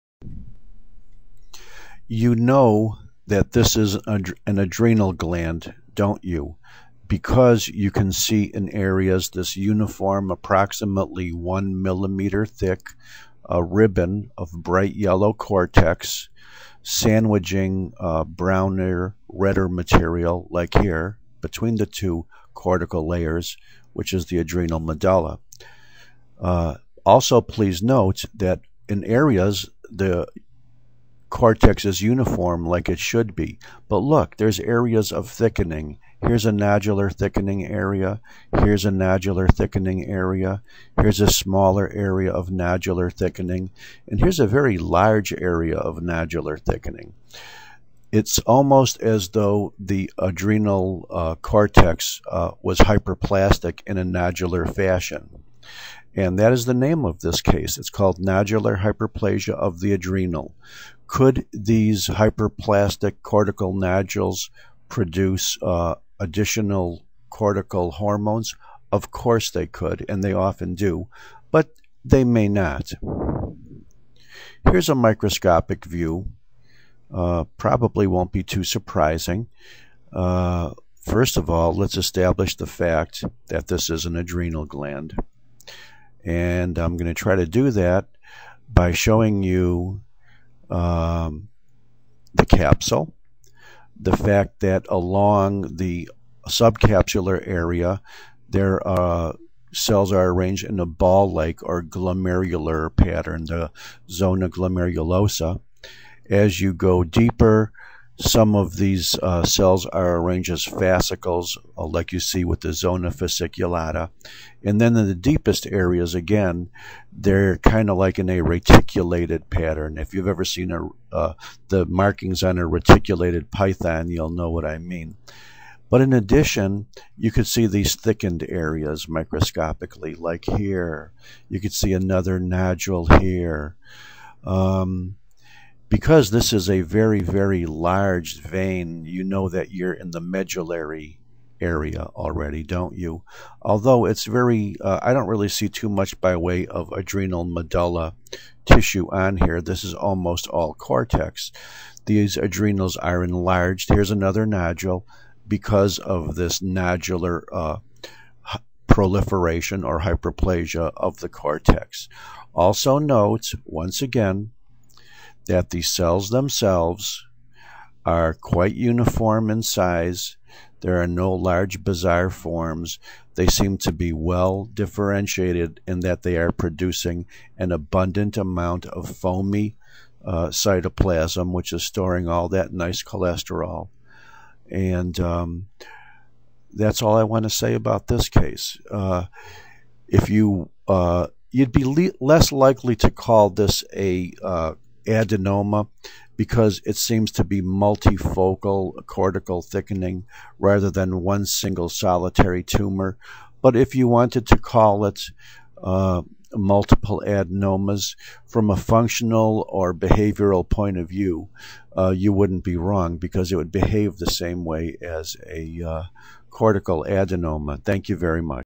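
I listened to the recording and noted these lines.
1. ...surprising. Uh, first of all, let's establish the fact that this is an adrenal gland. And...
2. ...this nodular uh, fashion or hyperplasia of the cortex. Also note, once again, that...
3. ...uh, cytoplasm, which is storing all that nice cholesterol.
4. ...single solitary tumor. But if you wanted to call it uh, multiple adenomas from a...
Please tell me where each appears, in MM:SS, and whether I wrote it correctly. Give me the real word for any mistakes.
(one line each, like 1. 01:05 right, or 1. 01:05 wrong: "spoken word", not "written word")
1. 01:18 right
2. 02:36 wrong: "proliferation", not "fashion"
3. 03:00 right
4. 03:21 right.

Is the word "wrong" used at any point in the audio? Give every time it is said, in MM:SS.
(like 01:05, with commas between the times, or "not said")
03:32.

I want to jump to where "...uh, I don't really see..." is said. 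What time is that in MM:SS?
02:24.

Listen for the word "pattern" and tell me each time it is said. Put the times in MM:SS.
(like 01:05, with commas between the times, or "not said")
01:42, 01:59.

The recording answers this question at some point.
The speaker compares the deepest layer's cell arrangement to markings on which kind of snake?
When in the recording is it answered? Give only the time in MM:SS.
02:02.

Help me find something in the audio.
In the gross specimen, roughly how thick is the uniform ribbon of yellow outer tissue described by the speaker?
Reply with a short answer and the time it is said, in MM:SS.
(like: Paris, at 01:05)
1 millimeter, at 00:11.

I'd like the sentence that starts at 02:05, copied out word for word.
But in addition, you could see these thickened areas microscopically, like here.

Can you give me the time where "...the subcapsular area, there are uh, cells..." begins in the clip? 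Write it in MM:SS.
01:35.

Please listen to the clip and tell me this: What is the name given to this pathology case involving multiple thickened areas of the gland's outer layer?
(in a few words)
Nodular hyperplasia of the adrenal.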